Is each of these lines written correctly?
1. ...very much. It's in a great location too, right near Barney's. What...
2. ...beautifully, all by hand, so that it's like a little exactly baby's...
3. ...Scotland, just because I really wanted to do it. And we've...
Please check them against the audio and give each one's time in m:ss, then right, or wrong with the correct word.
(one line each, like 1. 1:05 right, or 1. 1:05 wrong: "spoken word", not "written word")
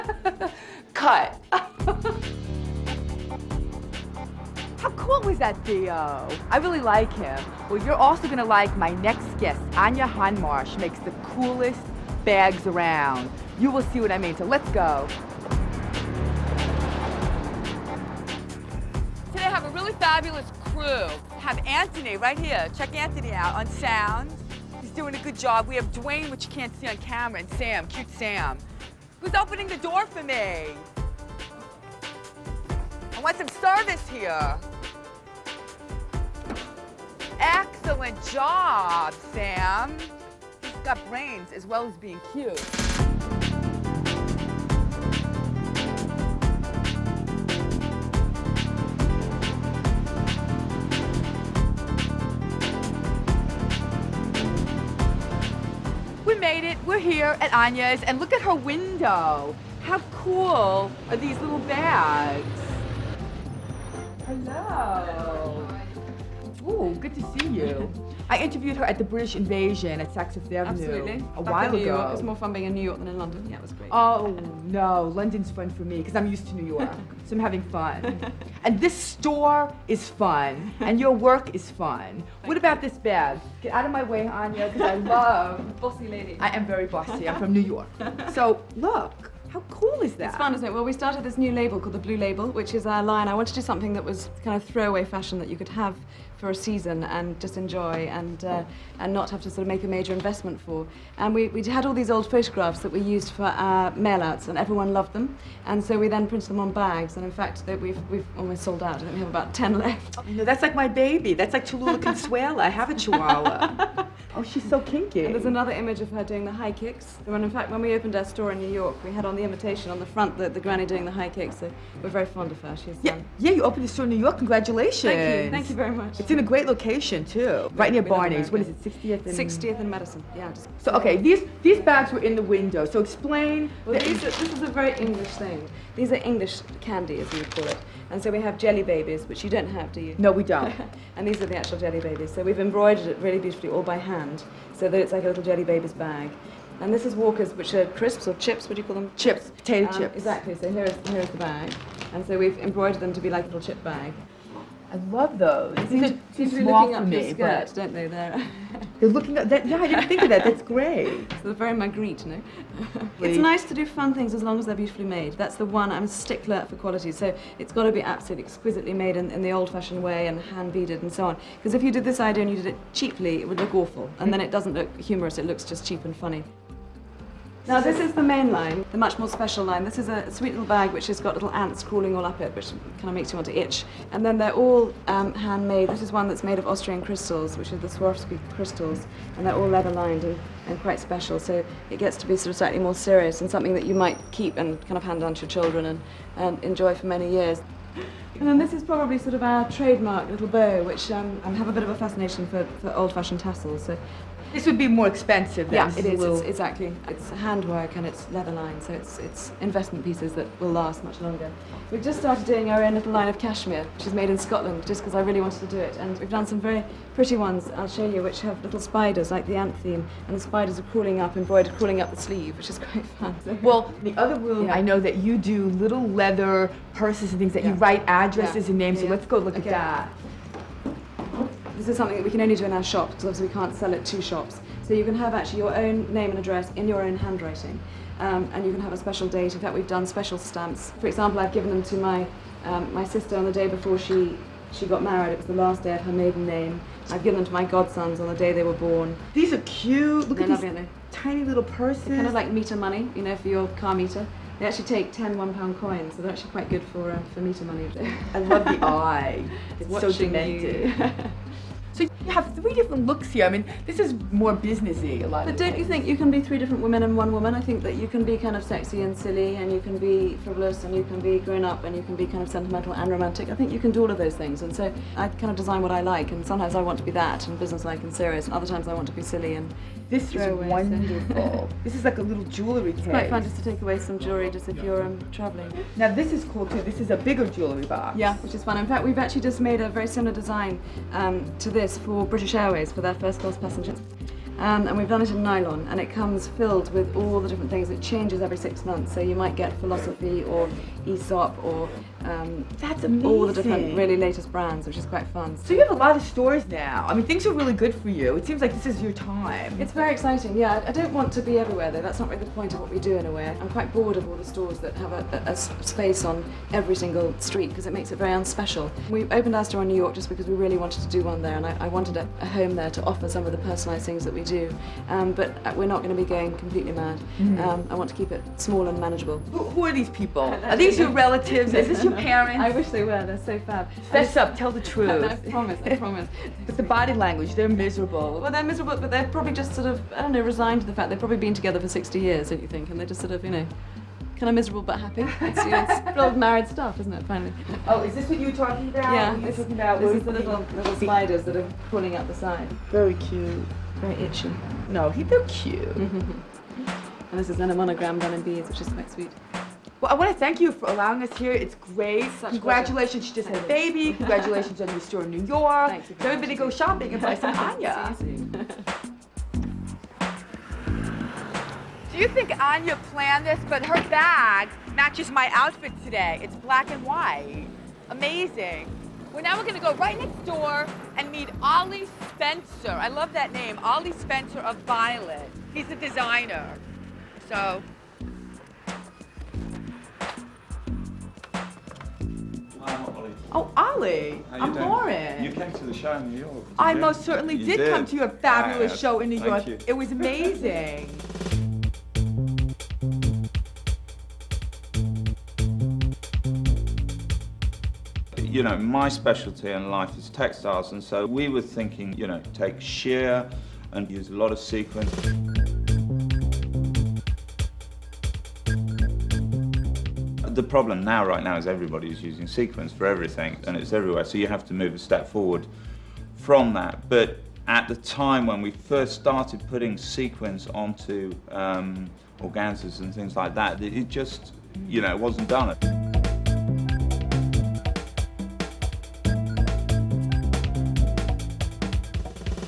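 1. 2:05 right
2. 2:23 wrong: "jelly", not "exactly"
3. 3:34 right.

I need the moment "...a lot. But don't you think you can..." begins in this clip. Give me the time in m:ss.
4:25.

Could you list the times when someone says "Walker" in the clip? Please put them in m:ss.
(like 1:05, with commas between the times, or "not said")
2:27.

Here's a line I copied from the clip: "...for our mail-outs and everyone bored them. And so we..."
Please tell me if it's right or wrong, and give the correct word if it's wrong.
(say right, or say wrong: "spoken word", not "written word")
wrong: "loved", not "bored".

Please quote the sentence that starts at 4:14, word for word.
They actually take 10 one pound coins, so they're actually quite good for, uh, for meter money.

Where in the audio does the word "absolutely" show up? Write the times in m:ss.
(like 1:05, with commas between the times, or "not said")
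1:10, 2:48.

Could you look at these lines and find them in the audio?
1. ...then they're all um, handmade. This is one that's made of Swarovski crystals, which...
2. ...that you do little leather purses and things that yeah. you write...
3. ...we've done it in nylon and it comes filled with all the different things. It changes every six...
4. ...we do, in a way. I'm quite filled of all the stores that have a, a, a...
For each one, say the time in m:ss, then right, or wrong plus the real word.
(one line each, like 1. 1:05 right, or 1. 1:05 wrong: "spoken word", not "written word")
1. 3:04 wrong: "Austrian", not "Swarovski"
2. 3:44 right
3. 4:54 right
4. 5:12 wrong: "bored", not "filled".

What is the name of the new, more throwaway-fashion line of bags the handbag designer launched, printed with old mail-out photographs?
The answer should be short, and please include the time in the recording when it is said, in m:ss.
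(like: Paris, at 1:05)
Blue Label, at 1:31.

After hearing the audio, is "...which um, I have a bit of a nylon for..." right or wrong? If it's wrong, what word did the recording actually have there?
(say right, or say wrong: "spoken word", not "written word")
wrong: "fascination", not "nylon".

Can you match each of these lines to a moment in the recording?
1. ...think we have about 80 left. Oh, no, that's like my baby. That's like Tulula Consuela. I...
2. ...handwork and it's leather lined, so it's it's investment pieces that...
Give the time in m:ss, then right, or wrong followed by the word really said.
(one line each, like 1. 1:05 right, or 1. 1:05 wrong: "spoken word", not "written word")
1. 1:48 wrong: "10", not "80"
2. 3:27 right.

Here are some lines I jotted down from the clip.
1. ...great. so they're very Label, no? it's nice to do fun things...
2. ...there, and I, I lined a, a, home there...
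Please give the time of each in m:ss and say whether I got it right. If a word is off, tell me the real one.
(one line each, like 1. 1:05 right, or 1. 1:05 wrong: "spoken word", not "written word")
1. 2:40 wrong: "Magritte", not "Label"
2. 5:21 wrong: "wanted", not "lined".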